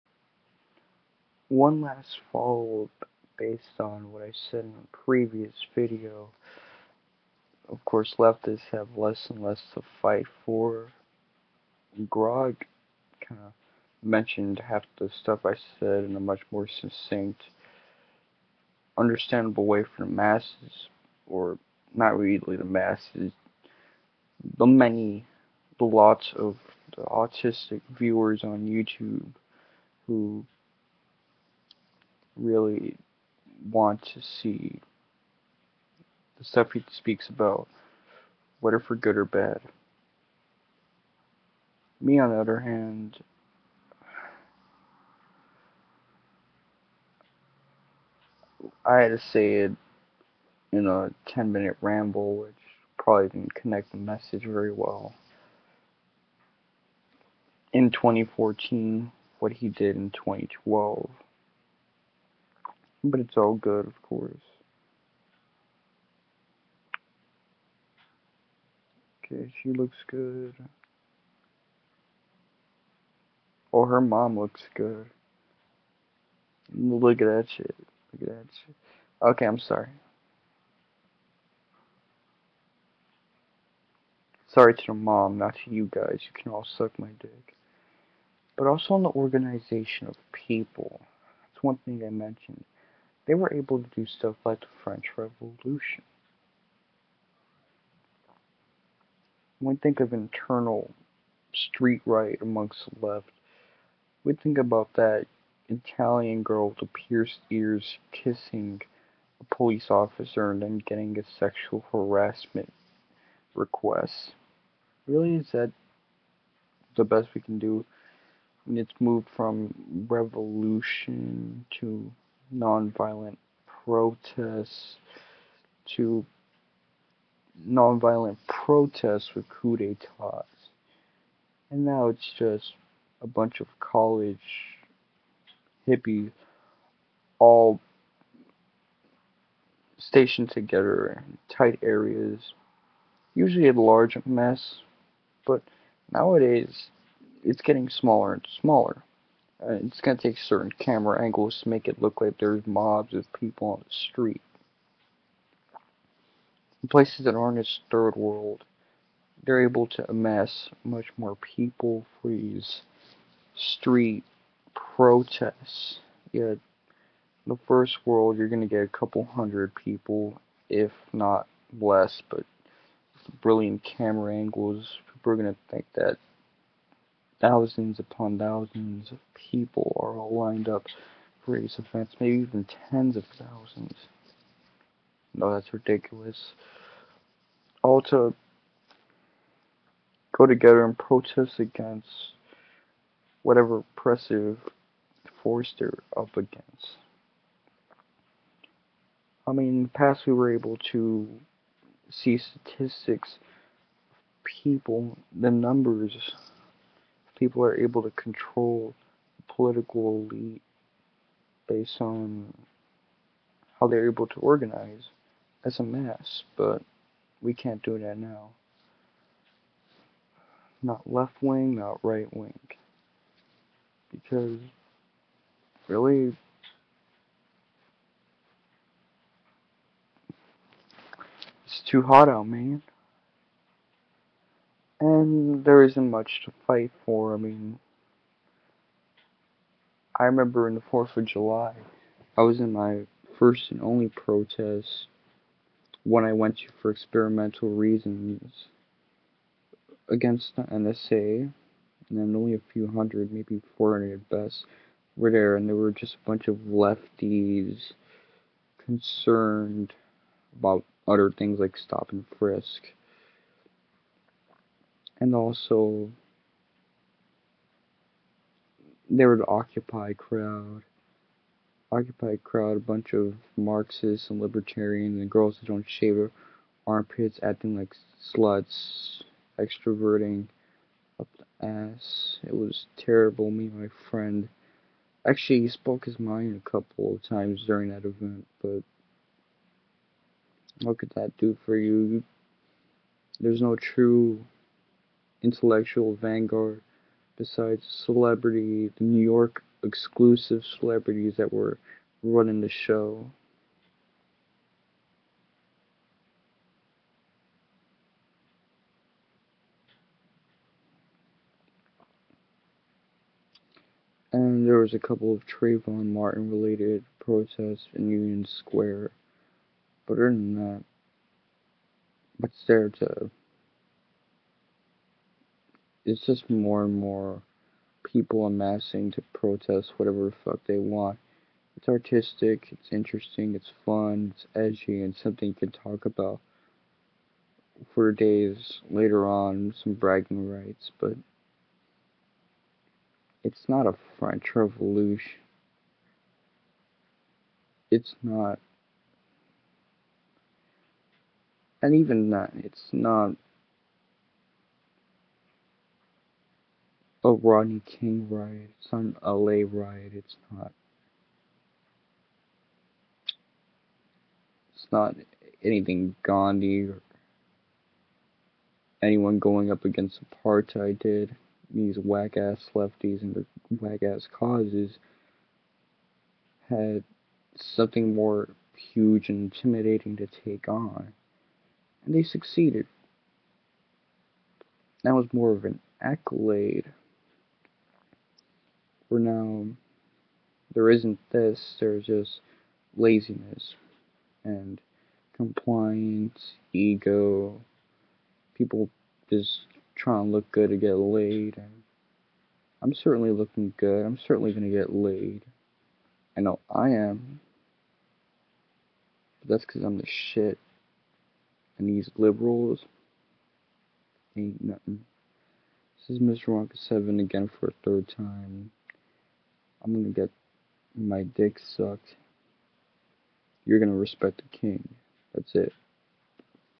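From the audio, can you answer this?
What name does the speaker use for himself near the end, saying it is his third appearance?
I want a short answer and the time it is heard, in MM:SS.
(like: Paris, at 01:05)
Mr. Wonka 7, at 06:56.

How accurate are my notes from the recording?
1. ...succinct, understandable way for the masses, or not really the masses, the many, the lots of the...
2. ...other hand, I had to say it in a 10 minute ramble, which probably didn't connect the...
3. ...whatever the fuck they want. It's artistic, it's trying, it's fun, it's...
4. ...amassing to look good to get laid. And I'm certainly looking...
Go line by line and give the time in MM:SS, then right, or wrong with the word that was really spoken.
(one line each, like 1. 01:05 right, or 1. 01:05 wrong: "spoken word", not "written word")
1. 00:16 right
2. 00:42 right
3. 05:29 wrong: "interesting", not "trying"
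4. 06:39 wrong: "trying", not "amassing".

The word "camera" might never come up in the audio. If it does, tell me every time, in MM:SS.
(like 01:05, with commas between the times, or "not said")
02:30, 02:53.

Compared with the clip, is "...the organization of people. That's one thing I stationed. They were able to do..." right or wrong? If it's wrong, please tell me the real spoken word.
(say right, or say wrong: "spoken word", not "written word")
wrong: "mentioned", not "stationed".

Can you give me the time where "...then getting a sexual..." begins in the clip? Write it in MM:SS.
01:50.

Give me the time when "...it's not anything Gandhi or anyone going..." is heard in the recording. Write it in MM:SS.
06:04.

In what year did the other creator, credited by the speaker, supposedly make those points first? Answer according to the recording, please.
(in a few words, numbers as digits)
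2012.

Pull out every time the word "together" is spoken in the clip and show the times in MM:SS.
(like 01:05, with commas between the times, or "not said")
02:20, 03:10.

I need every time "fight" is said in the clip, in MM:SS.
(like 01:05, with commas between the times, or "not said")
00:10, 03:56.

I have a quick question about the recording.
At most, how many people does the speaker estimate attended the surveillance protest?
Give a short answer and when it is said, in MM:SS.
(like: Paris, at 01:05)
400, at 04:13.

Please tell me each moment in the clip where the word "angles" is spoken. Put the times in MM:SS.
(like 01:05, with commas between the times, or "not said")
02:31, 02:54.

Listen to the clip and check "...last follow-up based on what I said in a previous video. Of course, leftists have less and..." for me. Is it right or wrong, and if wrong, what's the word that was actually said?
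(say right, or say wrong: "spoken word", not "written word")
right.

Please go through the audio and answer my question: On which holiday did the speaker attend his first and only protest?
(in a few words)
4th of July.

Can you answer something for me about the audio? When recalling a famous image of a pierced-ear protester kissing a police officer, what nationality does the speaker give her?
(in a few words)
Italian.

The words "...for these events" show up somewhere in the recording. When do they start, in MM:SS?
03:01.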